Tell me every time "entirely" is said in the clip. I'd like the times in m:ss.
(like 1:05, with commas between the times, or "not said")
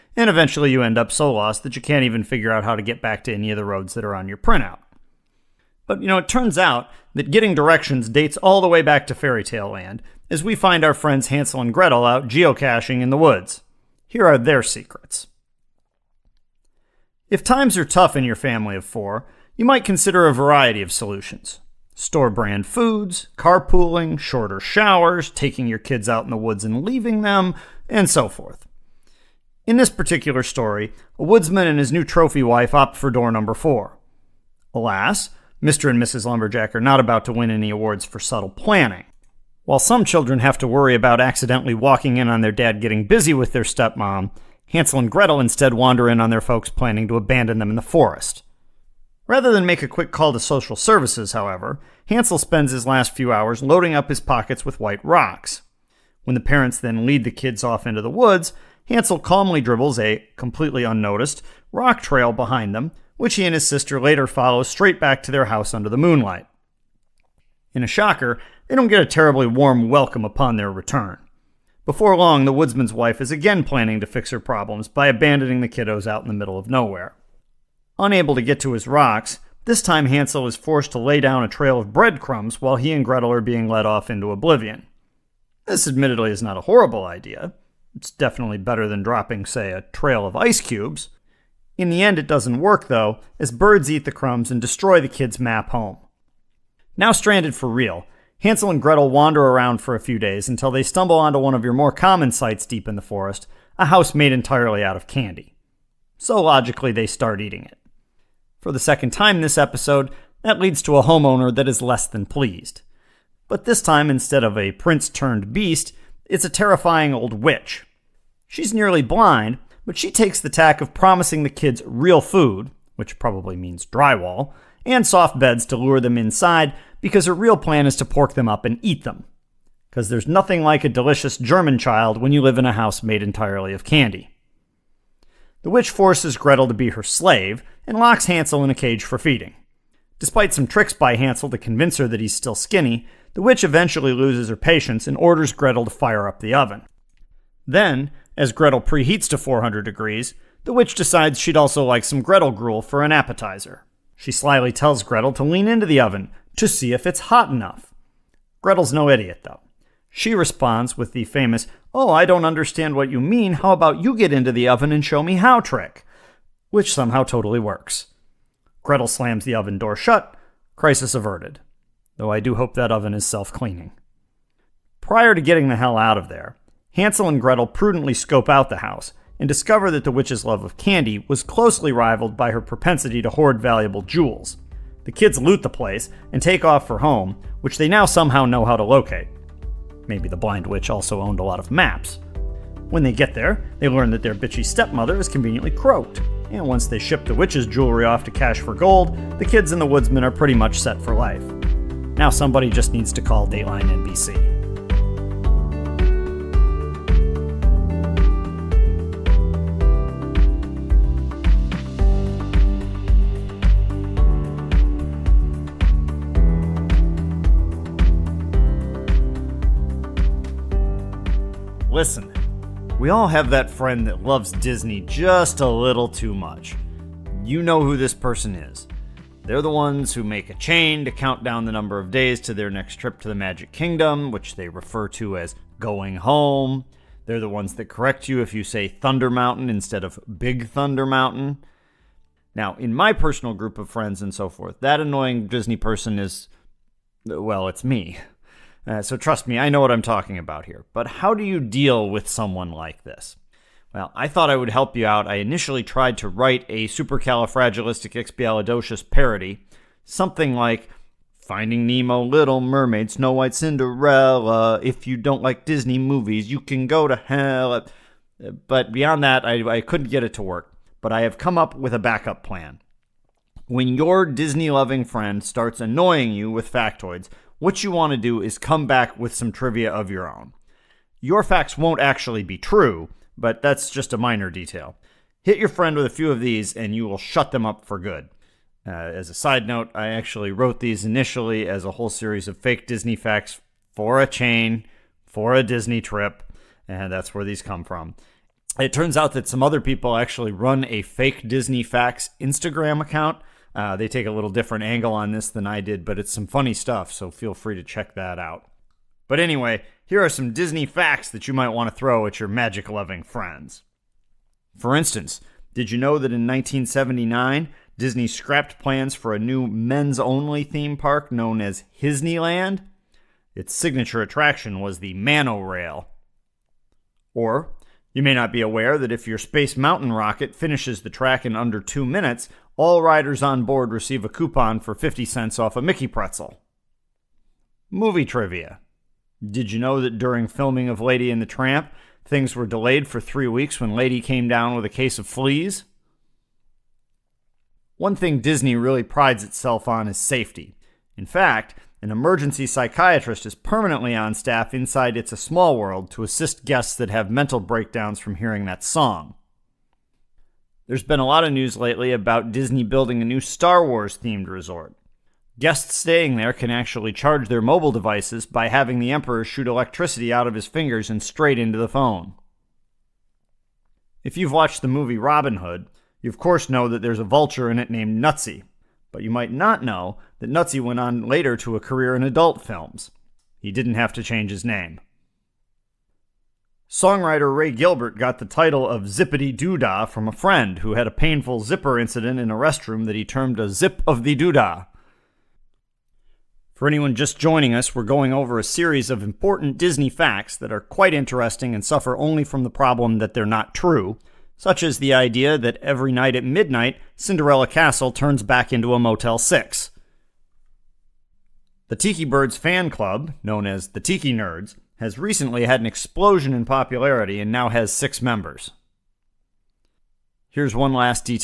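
1:44, 2:13.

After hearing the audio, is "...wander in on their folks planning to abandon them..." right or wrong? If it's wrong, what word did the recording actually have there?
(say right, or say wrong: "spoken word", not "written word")
right.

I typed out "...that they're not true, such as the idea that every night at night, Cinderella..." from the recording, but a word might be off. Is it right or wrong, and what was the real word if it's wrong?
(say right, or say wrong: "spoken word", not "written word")
wrong: "midnight", not "night".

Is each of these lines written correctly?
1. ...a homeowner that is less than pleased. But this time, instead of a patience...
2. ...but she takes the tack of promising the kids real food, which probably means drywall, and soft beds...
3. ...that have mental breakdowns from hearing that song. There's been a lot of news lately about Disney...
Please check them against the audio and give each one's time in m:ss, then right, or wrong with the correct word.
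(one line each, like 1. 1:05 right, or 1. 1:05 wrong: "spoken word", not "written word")
1. 1:50 wrong: "prince", not "patience"
2. 1:59 right
3. 5:56 right.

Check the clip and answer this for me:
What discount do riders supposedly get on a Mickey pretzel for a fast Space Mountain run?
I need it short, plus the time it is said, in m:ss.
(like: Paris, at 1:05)
50 cents, at 5:34.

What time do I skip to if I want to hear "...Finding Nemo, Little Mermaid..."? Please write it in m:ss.
4:21.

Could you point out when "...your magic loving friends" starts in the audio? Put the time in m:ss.
5:12.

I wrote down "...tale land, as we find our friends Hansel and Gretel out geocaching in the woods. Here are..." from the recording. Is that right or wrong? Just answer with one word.
right.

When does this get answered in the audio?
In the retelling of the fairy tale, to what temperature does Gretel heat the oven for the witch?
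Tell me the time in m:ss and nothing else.
2:29.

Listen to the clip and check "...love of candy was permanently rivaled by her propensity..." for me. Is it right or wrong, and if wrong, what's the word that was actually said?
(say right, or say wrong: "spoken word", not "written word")
wrong: "closely", not "permanently".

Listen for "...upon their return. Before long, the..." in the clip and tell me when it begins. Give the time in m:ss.
1:10.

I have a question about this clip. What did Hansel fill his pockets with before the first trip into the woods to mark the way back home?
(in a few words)
White rocks.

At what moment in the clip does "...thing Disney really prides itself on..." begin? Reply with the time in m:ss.
5:48.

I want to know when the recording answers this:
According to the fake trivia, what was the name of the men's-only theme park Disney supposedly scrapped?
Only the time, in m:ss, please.
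5:22.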